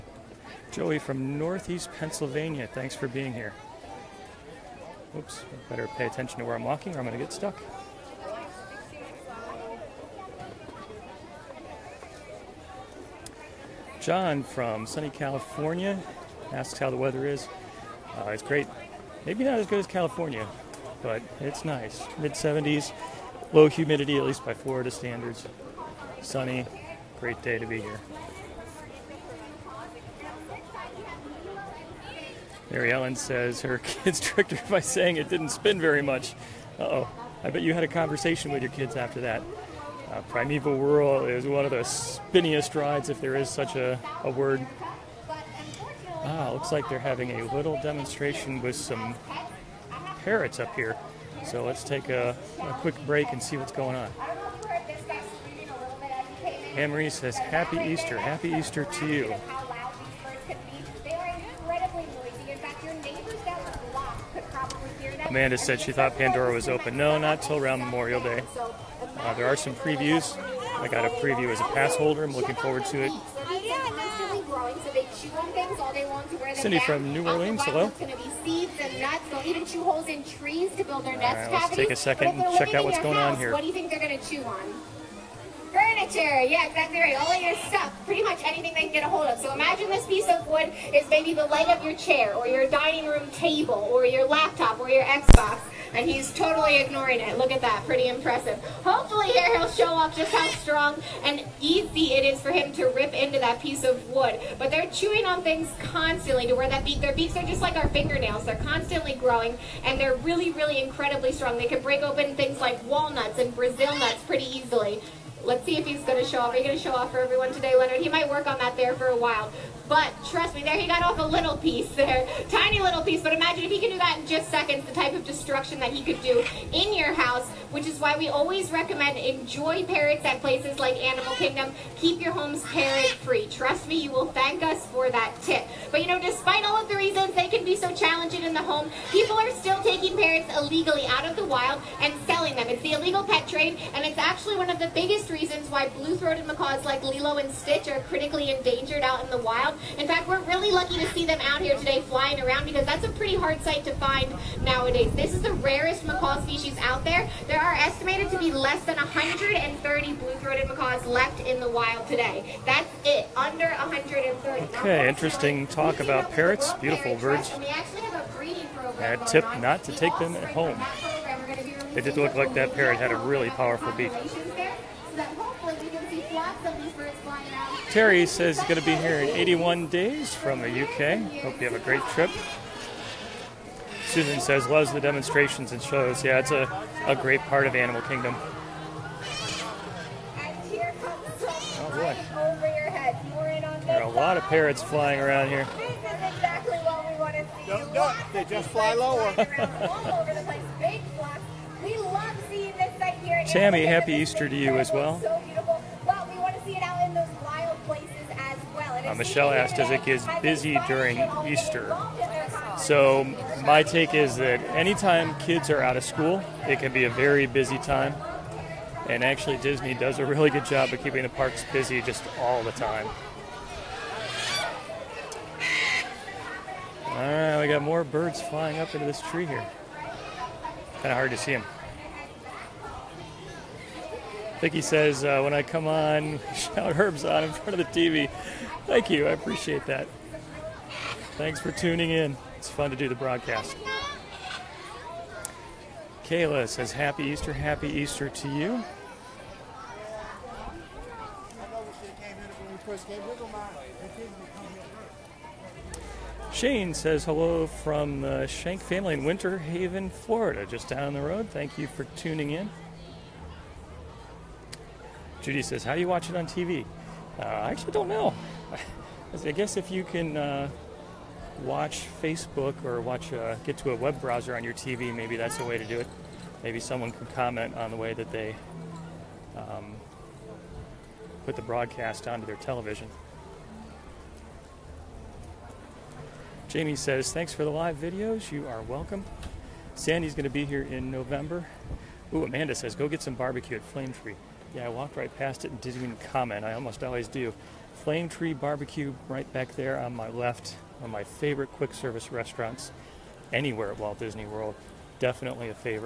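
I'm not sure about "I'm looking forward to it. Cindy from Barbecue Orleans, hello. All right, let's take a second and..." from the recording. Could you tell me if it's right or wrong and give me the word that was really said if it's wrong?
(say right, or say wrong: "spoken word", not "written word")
wrong: "New", not "Barbecue".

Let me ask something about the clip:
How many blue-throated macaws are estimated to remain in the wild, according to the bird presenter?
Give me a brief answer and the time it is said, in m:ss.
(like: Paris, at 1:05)
Less than 130, at 2:38.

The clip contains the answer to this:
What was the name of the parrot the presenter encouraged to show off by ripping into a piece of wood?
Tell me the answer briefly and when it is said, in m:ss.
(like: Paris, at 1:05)
Leonard, at 1:57.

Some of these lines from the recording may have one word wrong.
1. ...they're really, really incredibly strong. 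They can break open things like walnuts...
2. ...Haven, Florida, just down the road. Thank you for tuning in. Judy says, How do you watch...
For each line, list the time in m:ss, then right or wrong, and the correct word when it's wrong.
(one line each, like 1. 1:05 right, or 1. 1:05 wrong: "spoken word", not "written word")
1. 1:49 right
2. 4:19 right.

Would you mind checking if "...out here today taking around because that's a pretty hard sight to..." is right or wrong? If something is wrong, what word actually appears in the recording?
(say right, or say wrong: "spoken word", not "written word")
wrong: "flying", not "taking".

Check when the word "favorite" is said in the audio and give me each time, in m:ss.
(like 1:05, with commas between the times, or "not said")
5:01.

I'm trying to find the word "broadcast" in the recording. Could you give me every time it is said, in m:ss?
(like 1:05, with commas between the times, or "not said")
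4:03, 4:41.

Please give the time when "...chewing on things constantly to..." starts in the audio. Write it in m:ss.
1:44.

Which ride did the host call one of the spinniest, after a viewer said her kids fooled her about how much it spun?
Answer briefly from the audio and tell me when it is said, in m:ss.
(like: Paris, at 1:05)
Primeval Whirl, at 0:40.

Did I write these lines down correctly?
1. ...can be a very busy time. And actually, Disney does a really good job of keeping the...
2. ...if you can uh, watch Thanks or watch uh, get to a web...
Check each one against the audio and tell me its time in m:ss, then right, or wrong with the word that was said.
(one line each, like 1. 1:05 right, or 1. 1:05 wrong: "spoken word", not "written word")
1. 3:36 right
2. 4:29 wrong: "Facebook", not "Thanks".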